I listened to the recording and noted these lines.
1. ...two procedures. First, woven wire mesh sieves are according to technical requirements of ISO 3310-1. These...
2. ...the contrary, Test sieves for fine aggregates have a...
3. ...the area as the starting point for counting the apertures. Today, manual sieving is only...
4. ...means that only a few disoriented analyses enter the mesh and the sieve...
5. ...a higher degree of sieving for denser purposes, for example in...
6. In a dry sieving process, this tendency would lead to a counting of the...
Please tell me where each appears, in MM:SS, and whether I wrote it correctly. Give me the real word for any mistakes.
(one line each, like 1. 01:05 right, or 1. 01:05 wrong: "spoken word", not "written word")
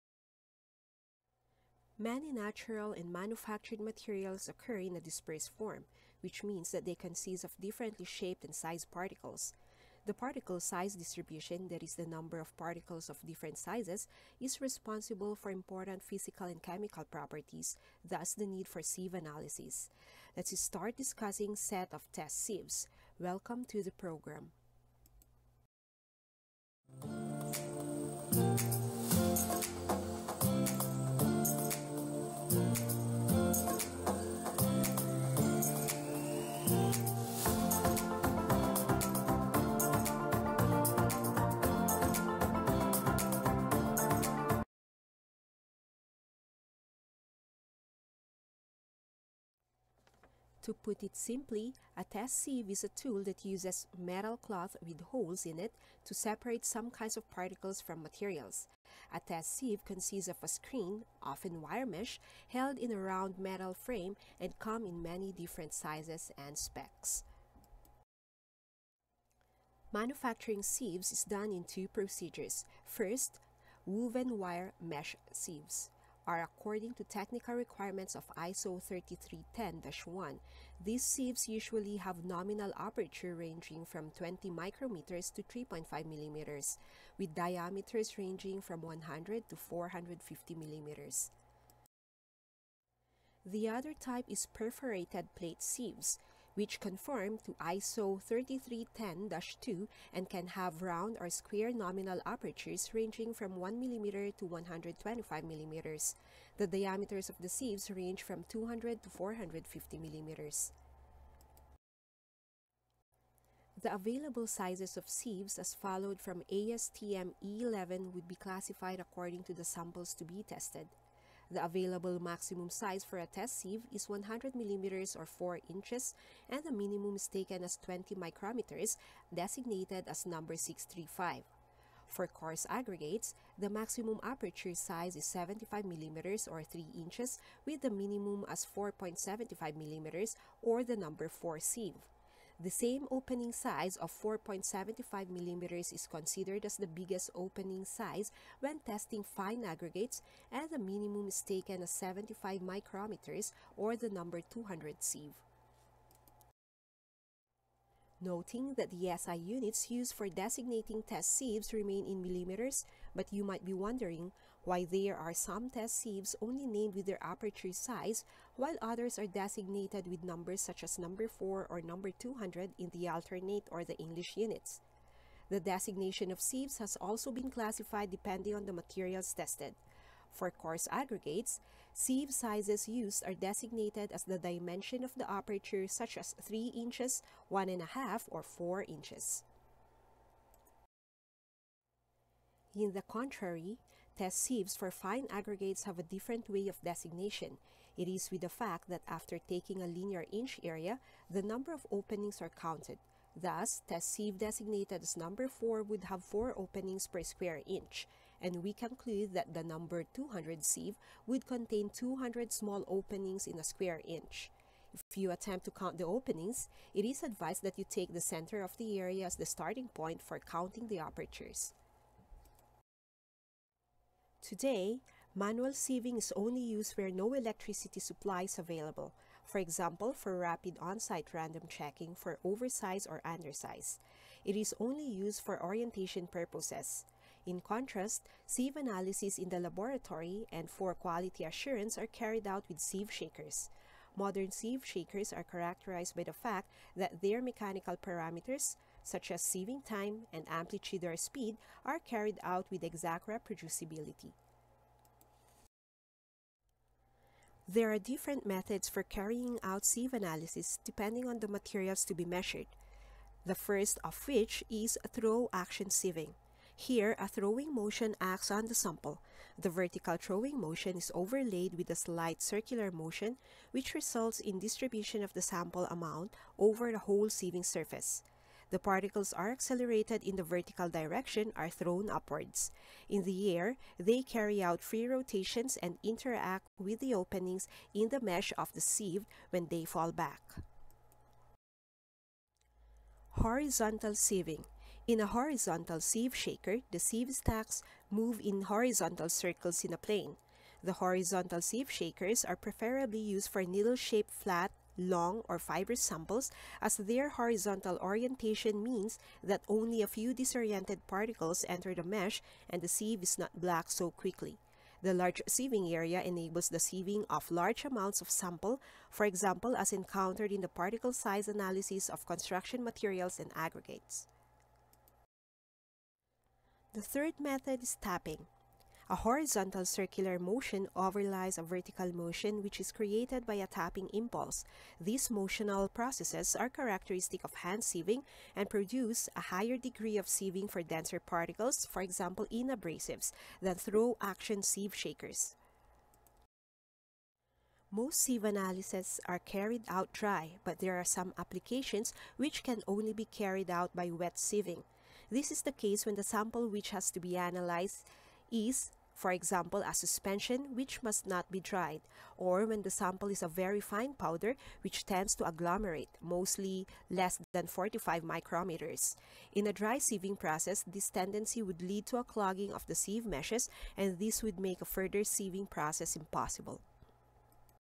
1. 01:11 right
2. 03:12 right
3. 03:38 right
4. 05:08 wrong: "particles", not "analyses"
5. 05:39 wrong: "particles", not "purposes"
6. 06:09 wrong: "clogging", not "counting".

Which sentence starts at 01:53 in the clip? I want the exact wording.
The available sizes of sieves as followed from ASTM E11 would be classified according to the samples to be tested.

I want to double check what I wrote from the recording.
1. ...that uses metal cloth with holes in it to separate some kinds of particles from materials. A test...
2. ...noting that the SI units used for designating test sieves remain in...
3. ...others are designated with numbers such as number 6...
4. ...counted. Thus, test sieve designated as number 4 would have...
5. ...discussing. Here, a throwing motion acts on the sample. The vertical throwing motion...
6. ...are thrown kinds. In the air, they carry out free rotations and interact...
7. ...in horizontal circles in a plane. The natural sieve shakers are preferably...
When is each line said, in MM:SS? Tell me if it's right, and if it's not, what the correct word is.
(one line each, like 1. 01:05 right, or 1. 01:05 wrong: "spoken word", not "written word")
1. 00:53 right
2. 02:38 right
3. 02:48 wrong: "4", not "6"
4. 03:22 right
5. 04:25 wrong: "sieving", not "discussing"
6. 04:41 wrong: "upwards", not "kinds"
7. 04:58 wrong: "horizontal", not "natural".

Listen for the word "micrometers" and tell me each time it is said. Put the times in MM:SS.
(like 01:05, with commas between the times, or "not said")
01:24, 02:08, 02:32, 06:08.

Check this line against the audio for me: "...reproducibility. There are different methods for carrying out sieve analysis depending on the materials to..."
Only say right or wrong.
right.